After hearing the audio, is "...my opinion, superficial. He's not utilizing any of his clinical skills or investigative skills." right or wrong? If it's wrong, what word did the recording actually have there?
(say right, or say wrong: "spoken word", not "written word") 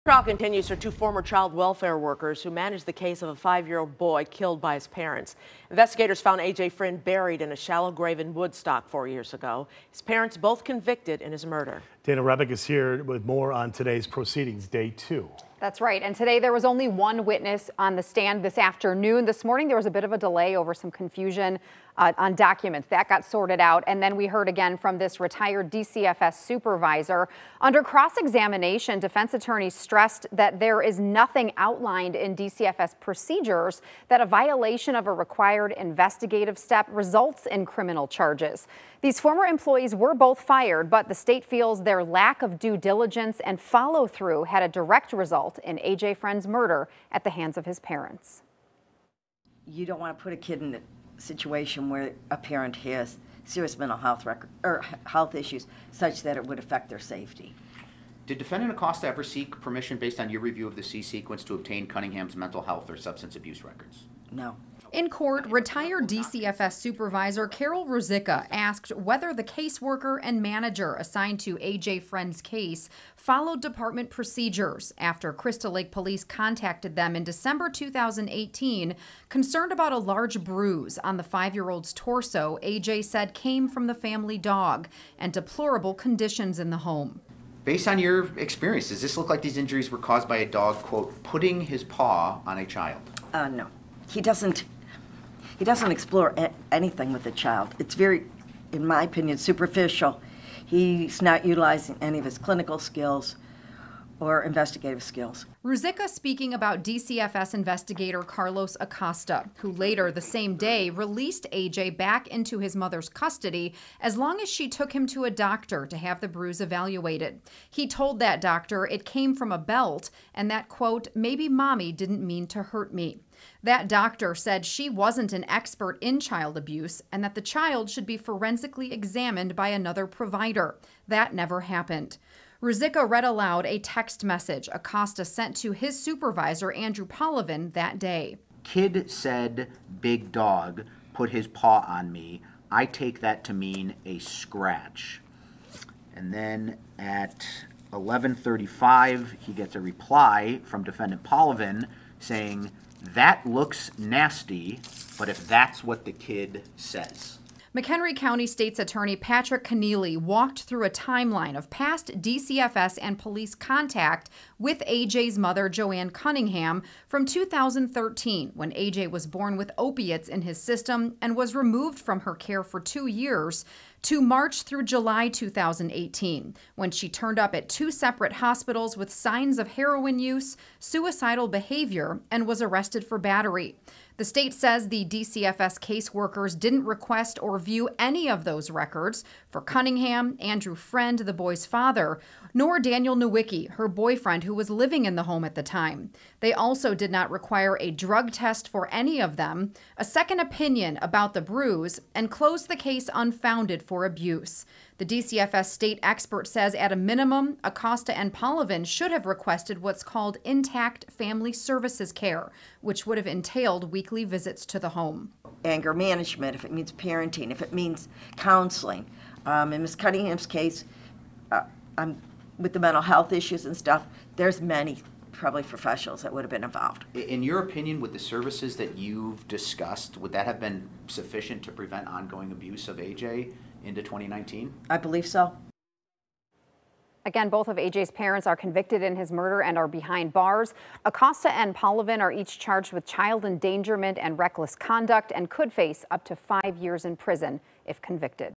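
right.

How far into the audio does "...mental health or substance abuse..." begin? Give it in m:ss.
1:02.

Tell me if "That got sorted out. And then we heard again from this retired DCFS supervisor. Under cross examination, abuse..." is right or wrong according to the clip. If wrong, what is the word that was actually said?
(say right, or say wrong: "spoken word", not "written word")
wrong: "defense", not "abuse".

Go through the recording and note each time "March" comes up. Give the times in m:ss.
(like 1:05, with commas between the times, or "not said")
2:54.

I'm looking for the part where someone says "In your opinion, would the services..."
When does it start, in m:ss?
3:47.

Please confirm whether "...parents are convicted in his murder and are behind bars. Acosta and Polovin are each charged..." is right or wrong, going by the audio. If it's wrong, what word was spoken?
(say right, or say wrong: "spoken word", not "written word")
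right.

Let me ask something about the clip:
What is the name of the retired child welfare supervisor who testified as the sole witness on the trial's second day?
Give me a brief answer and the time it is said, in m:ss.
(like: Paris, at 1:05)
Carol Ruzicka, at 1:07.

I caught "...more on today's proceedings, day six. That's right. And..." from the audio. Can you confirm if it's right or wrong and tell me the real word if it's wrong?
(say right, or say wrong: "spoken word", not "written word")
wrong: "two", not "six".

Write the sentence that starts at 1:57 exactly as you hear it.
He told that doctor it came from a belt and that, quote, maybe mommy didn't mean to hurt me.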